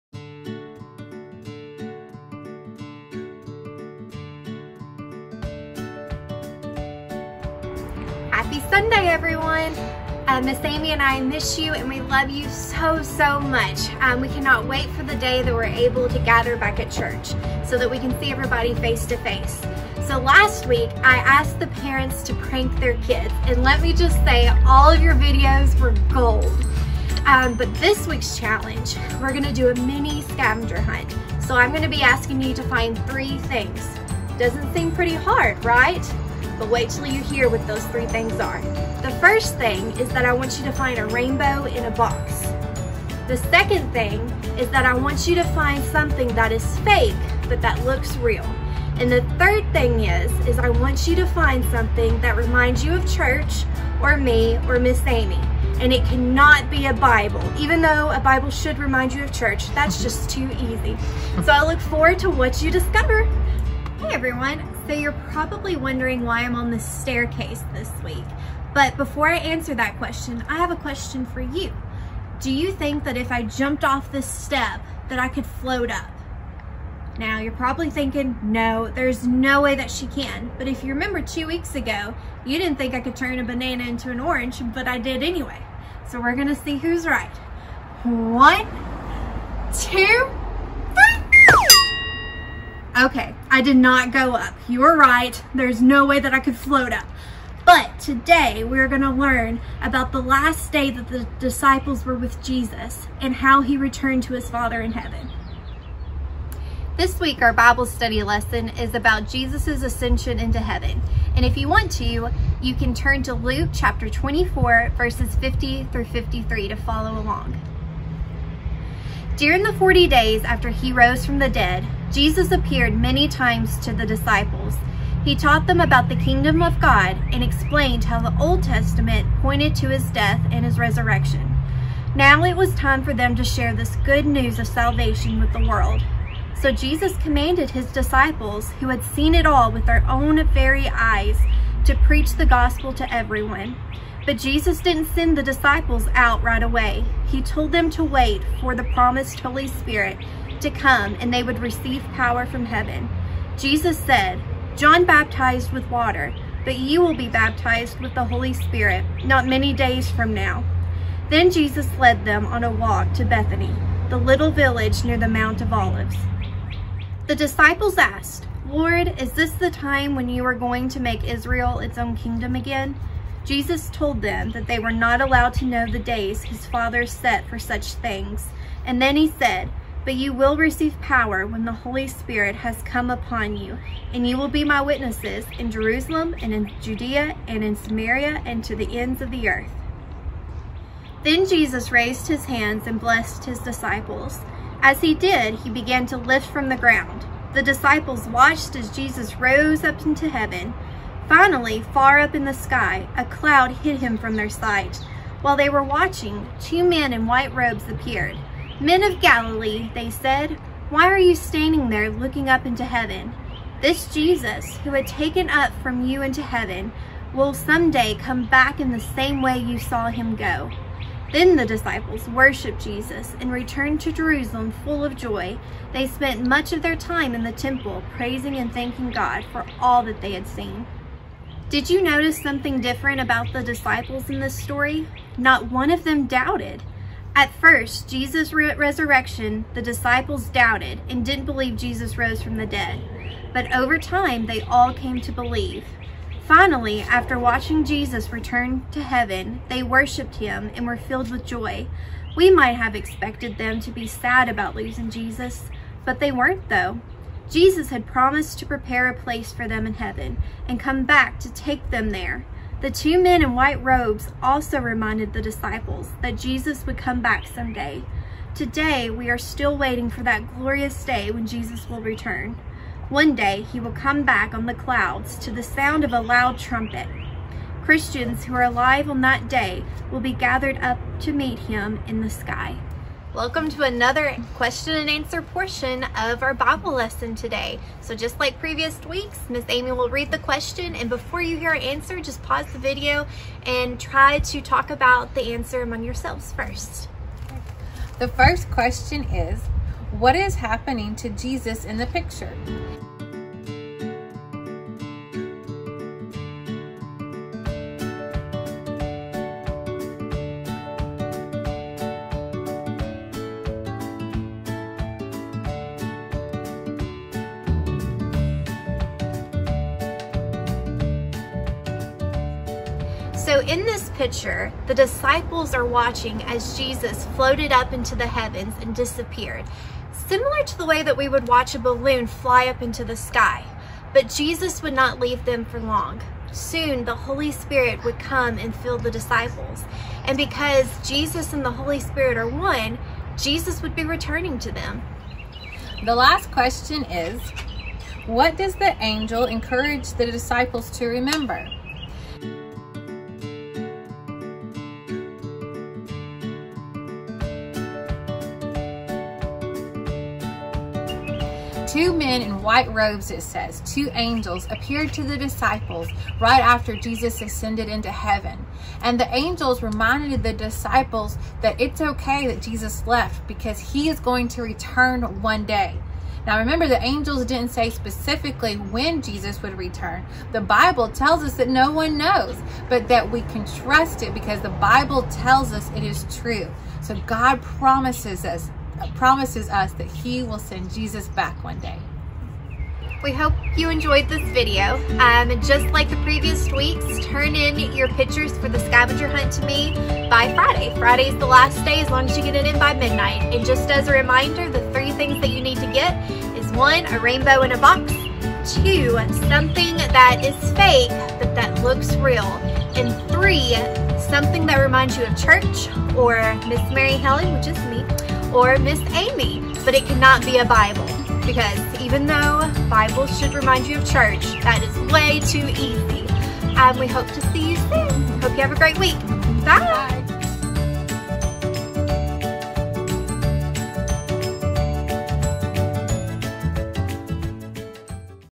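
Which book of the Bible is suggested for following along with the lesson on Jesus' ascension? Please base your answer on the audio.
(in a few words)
Luke.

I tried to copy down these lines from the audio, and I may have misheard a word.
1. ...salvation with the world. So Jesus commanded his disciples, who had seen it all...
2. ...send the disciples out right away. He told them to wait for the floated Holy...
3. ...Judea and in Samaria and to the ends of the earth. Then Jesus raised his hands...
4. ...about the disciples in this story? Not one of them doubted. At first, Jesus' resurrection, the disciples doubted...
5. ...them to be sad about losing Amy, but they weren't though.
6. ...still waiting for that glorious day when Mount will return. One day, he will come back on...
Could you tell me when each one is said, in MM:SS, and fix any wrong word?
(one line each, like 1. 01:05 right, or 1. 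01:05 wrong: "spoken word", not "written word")
1. 02:14 right
2. 02:25 wrong: "promised", not "floated"
3. 03:06 right
4. 03:53 right
5. 04:13 wrong: "Jesus", not "Amy"
6. 04:29 wrong: "Jesus", not "Mount".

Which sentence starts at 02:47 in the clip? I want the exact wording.
The disciples asked, Lord, is this the time when you are going to make Israel its own kingdom again?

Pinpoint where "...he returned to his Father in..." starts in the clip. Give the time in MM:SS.
01:43.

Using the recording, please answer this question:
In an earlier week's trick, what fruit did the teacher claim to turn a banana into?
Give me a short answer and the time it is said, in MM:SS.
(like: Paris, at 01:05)
An orange, at 01:23.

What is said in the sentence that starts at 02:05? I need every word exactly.
He taught them about the kingdom of God and explained how the Old Testament pointed to his death and his resurrection.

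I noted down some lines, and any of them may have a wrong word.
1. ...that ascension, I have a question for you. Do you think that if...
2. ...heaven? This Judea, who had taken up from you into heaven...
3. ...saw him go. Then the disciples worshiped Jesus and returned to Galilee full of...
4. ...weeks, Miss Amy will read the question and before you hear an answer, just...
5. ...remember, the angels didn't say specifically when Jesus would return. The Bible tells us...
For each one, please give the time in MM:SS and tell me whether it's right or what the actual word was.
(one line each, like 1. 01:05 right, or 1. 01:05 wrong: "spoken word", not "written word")
1. 01:09 wrong: "question", not "ascension"
2. 03:32 wrong: "Jesus", not "Judea"
3. 03:39 wrong: "Jerusalem", not "Galilee"
4. 04:49 right
5. 06:16 right.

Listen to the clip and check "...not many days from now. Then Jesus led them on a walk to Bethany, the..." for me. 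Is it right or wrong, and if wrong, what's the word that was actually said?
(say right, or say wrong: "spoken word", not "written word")
right.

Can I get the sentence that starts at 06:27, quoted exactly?
So God promises us promises us that he will send Jesus back one day.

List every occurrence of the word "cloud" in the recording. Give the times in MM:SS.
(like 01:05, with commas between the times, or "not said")
03:23, 04:34.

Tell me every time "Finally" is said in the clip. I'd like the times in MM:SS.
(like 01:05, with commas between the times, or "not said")
03:21, 04:06.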